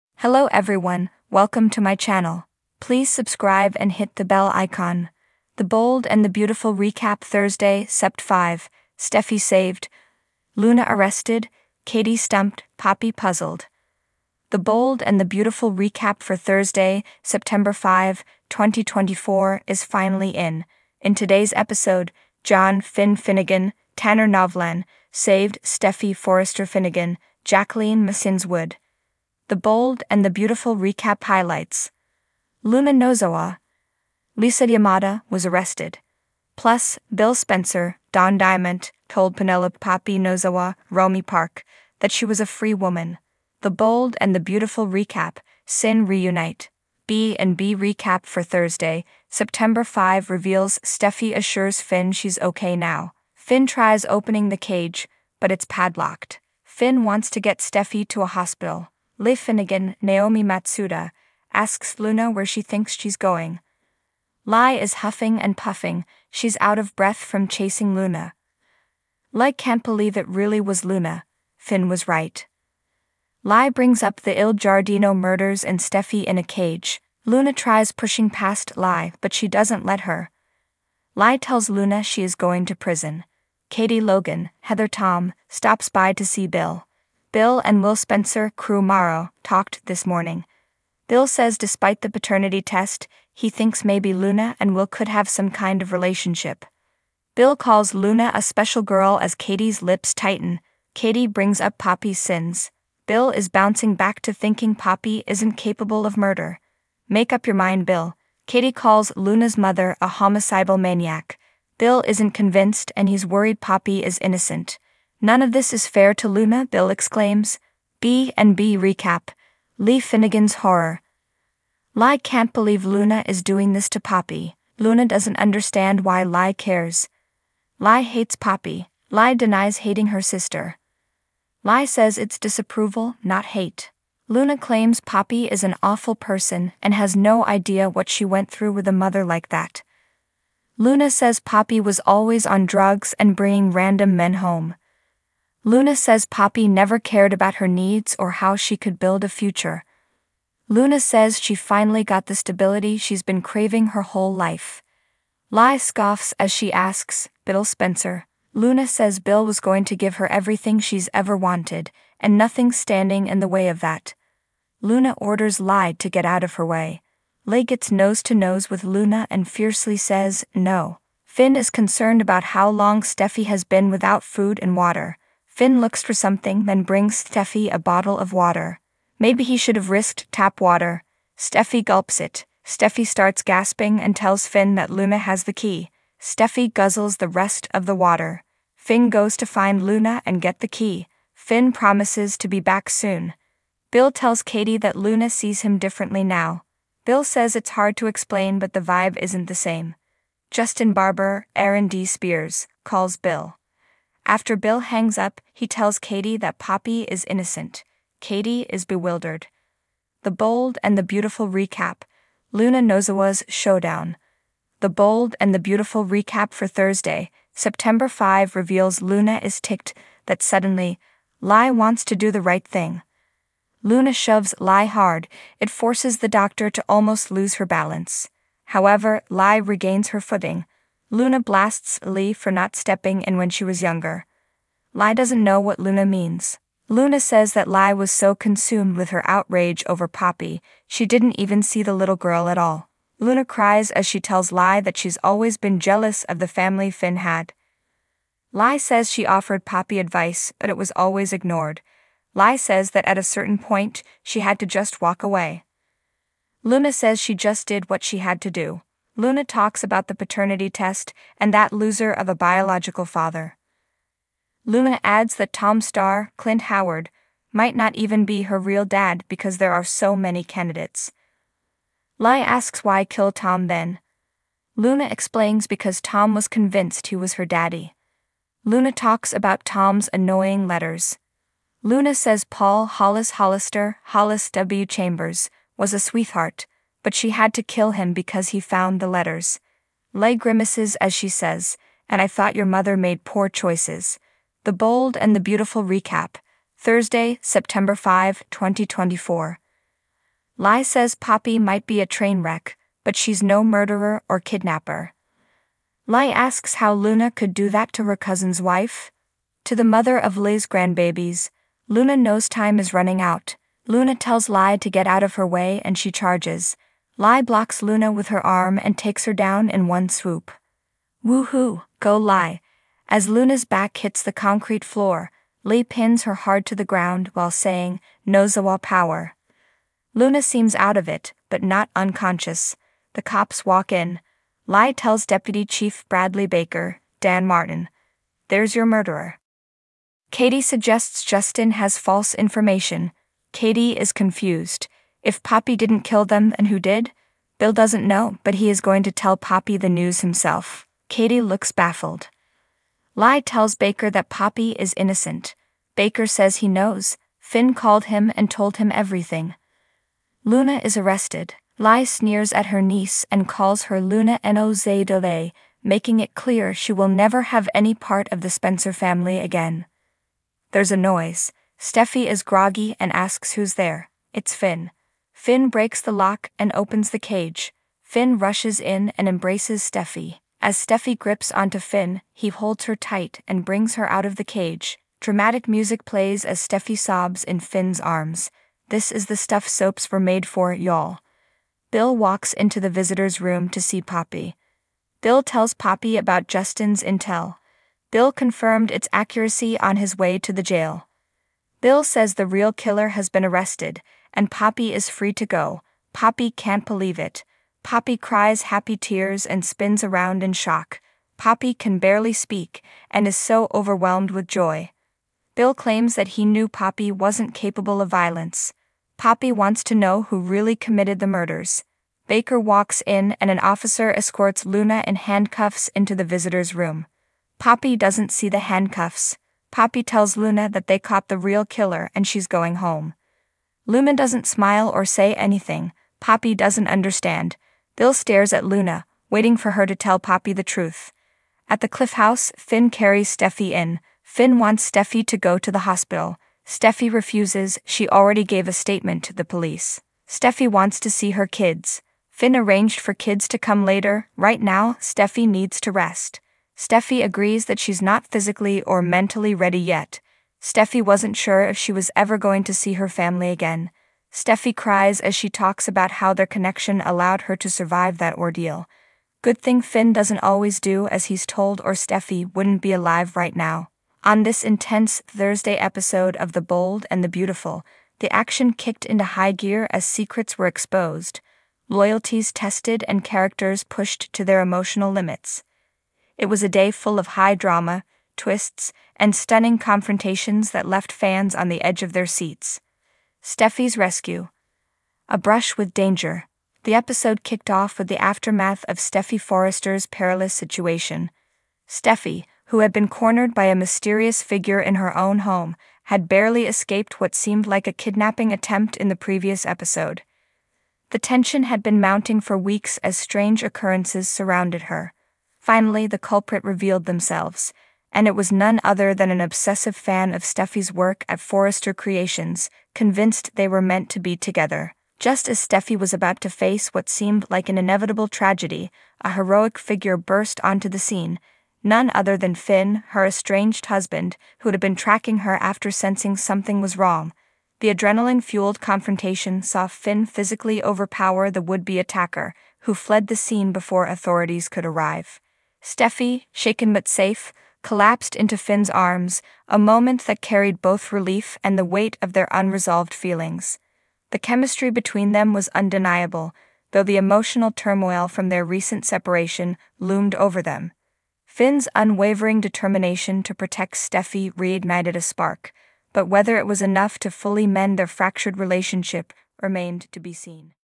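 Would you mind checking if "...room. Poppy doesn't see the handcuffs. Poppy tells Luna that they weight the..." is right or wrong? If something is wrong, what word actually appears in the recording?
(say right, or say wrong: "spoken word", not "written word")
wrong: "caught", not "weight".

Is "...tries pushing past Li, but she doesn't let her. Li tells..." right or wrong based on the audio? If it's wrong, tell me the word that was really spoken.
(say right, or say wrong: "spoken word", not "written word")
right.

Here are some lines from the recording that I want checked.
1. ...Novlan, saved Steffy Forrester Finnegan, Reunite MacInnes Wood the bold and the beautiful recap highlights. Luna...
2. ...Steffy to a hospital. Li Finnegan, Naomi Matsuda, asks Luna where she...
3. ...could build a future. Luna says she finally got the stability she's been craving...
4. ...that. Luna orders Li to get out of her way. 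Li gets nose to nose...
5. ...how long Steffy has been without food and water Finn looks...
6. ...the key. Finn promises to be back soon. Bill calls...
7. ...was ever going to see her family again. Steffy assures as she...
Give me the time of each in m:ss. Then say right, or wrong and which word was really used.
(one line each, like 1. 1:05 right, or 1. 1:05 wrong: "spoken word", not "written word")
1. 0:24 wrong: "Jacqueline", not "Reunite"
2. 0:57 right
3. 2:28 right
4. 2:43 right
5. 2:52 right
6. 3:10 wrong: "tells", not "calls"
7. 7:41 wrong: "cries", not "assures".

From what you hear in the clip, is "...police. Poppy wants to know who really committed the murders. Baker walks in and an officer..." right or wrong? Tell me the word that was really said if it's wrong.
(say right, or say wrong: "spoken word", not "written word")
wrong: "violence", not "police".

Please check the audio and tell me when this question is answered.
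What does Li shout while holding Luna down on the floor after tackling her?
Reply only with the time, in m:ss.
5:28.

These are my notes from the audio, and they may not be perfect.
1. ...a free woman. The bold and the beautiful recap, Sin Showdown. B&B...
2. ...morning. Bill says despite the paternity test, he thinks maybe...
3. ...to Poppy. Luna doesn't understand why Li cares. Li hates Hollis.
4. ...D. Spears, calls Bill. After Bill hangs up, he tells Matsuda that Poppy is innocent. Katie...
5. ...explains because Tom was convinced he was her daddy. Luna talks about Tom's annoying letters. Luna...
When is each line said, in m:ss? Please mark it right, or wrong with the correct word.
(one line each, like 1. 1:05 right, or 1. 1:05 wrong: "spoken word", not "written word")
1. 0:42 wrong: "Reunite", not "Showdown"
2. 1:30 right
3. 2:03 wrong: "Poppy", not "Hollis"
4. 3:21 wrong: "Katie", not "Matsuda"
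5. 4:35 right.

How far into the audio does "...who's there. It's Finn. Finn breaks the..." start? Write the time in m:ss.
6:13.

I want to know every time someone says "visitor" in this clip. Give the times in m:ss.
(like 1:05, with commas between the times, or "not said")
6:32, 7:06.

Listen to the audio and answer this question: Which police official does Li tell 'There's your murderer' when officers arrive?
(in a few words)
Bradley Baker.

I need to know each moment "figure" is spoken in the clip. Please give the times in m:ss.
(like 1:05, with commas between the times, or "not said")
8:24, 8:49.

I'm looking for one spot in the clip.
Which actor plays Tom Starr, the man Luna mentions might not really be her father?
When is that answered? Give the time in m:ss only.
4:26.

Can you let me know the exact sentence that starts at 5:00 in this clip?
Li says Poppy might be a train wreck, but she's no murderer or kidnapper.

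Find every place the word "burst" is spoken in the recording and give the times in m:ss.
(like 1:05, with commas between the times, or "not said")
8:50.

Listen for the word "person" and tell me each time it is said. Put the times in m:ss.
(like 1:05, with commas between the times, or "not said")
2:16.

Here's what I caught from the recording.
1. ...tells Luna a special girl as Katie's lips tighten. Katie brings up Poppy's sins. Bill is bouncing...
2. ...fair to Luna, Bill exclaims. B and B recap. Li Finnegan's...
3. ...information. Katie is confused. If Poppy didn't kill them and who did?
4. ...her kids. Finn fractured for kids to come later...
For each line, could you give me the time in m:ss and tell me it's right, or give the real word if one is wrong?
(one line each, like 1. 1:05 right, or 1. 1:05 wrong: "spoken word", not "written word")
1. 1:37 wrong: "calls", not "tells"
2. 1:55 right
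3. 5:42 right
4. 7:31 wrong: "arranged", not "fractured".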